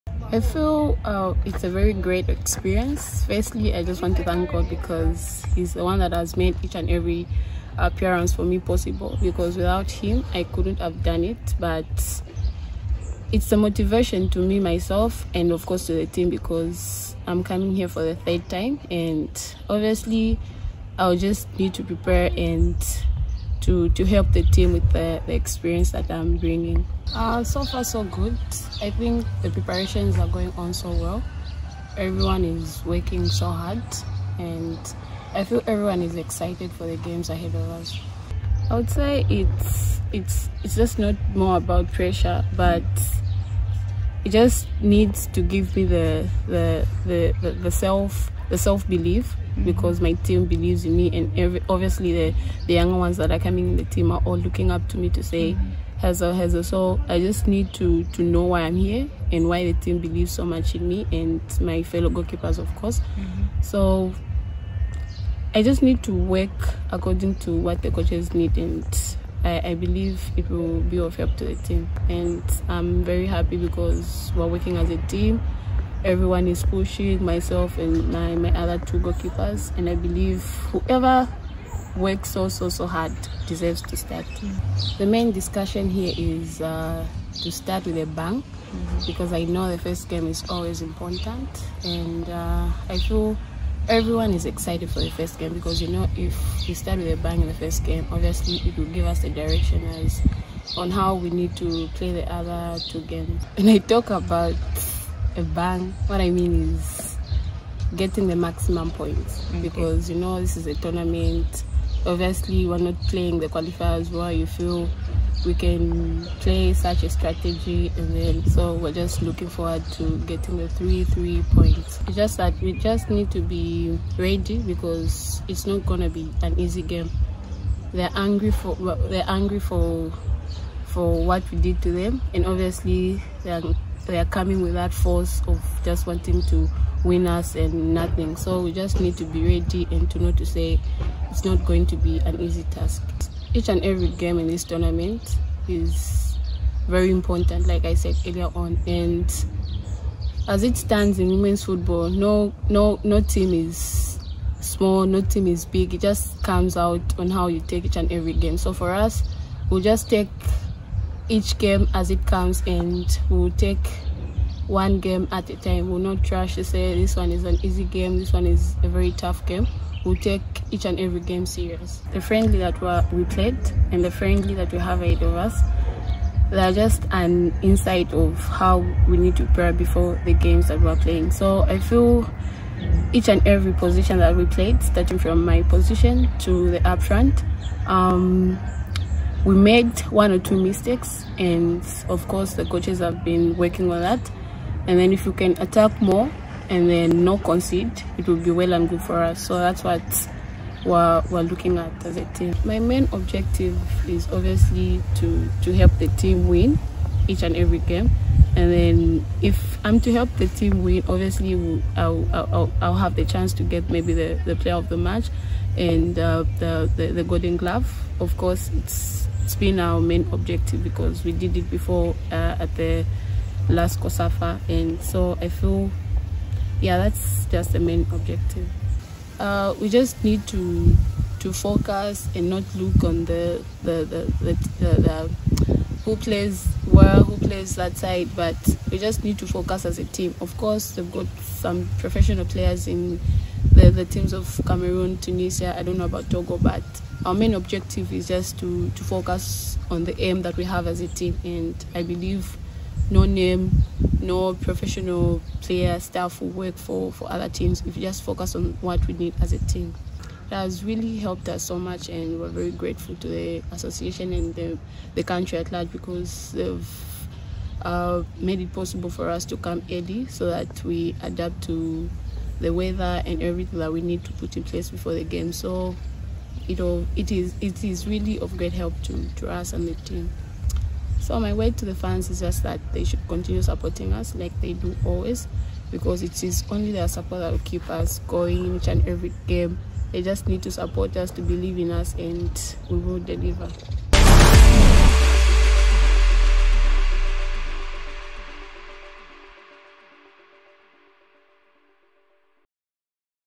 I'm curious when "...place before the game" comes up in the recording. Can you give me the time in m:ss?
4:34.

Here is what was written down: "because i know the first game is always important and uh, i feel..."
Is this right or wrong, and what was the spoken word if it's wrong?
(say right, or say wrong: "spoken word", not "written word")
right.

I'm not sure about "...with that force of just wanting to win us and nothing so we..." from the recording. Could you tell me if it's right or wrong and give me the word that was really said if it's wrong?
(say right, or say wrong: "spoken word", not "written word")
right.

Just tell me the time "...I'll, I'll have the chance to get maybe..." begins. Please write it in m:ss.
3:32.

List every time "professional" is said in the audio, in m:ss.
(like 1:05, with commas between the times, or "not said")
4:01, 4:14.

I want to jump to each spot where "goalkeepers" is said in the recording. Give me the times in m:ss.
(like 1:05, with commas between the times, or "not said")
1:02, 1:18.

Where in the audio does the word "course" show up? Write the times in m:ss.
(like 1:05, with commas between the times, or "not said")
0:15, 1:02, 3:12, 3:38, 4:00.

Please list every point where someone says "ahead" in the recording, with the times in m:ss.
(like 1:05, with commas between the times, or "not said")
0:37, 2:55.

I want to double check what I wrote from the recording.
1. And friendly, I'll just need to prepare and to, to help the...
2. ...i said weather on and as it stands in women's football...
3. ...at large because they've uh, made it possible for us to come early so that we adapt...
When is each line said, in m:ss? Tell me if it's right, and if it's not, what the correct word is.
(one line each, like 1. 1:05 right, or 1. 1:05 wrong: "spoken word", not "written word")
1. 0:18 wrong: "obviously", not "friendly"
2. 2:27 wrong: "earlier", not "weather"
3. 4:25 right.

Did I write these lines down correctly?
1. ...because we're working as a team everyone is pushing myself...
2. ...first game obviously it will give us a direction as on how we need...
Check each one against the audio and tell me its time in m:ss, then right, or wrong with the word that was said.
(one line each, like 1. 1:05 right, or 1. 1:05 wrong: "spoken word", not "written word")
1. 1:13 right
2. 1:37 right.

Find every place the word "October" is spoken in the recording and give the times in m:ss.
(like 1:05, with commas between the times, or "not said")
not said.